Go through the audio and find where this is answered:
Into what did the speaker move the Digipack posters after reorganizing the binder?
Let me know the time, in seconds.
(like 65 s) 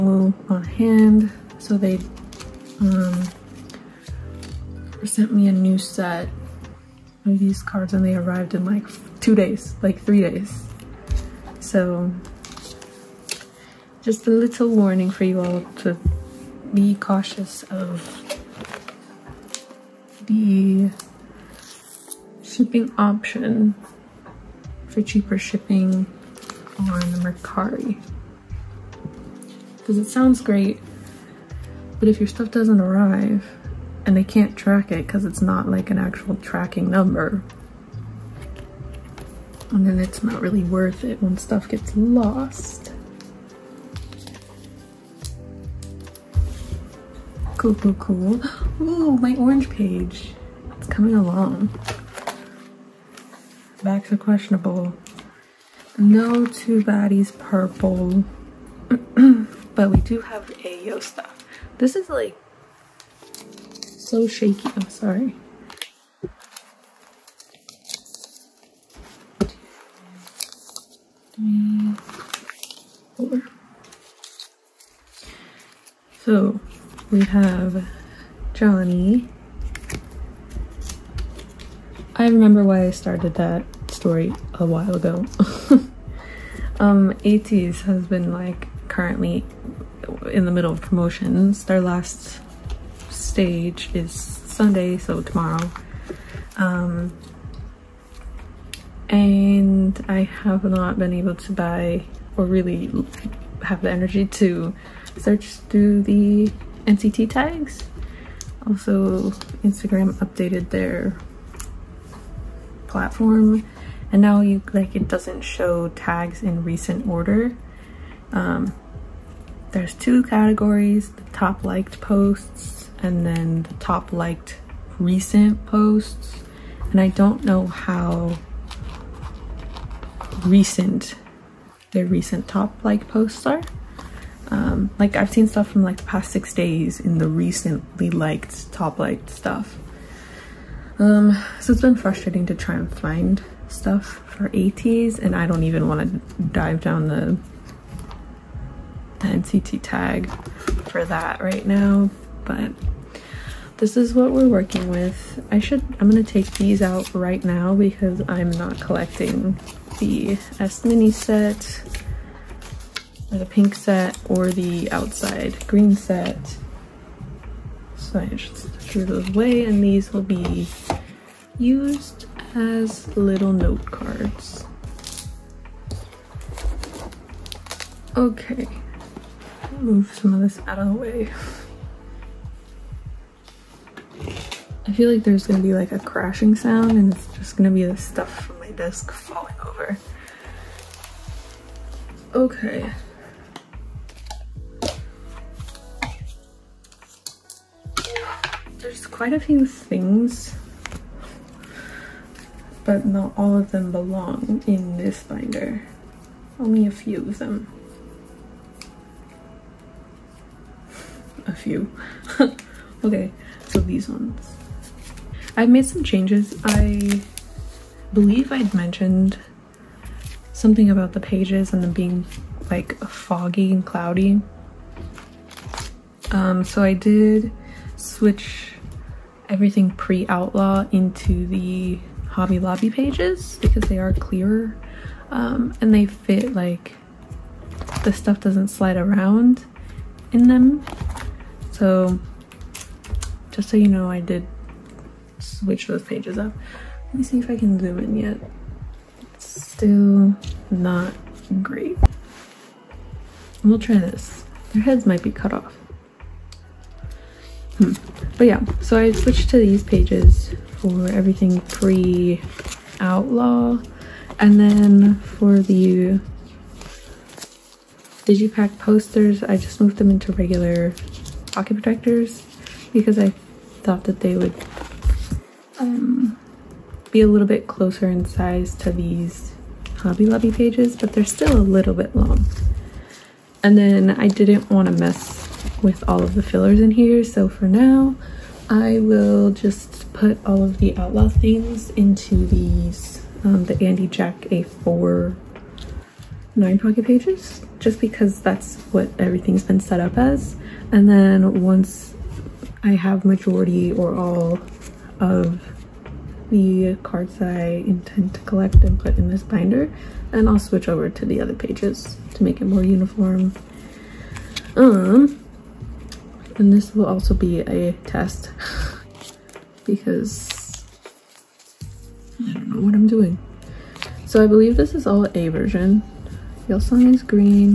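270 s.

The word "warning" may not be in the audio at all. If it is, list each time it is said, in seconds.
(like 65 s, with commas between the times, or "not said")
14 s.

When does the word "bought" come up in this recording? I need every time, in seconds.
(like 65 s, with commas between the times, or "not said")
not said.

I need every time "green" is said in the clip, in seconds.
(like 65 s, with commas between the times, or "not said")
165 s, 327 s.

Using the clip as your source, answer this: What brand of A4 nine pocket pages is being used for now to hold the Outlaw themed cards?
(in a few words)
Andy Jack.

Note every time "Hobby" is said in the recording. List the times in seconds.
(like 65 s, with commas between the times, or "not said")
232 s, 279 s.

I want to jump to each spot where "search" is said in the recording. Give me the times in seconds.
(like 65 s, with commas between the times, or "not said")
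105 s.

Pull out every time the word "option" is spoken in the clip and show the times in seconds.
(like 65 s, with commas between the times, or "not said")
22 s.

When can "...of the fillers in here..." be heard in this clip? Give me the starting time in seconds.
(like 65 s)
286 s.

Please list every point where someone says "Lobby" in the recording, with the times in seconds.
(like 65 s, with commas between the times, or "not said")
232 s, 280 s.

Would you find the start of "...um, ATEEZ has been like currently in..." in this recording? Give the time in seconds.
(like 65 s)
86 s.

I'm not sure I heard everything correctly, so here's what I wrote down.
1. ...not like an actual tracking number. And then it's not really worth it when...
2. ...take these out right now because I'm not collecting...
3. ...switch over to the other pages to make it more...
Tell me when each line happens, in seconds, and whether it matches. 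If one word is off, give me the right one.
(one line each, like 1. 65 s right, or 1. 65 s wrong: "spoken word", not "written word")
1. 35 s right
2. 156 s right
3. 310 s right.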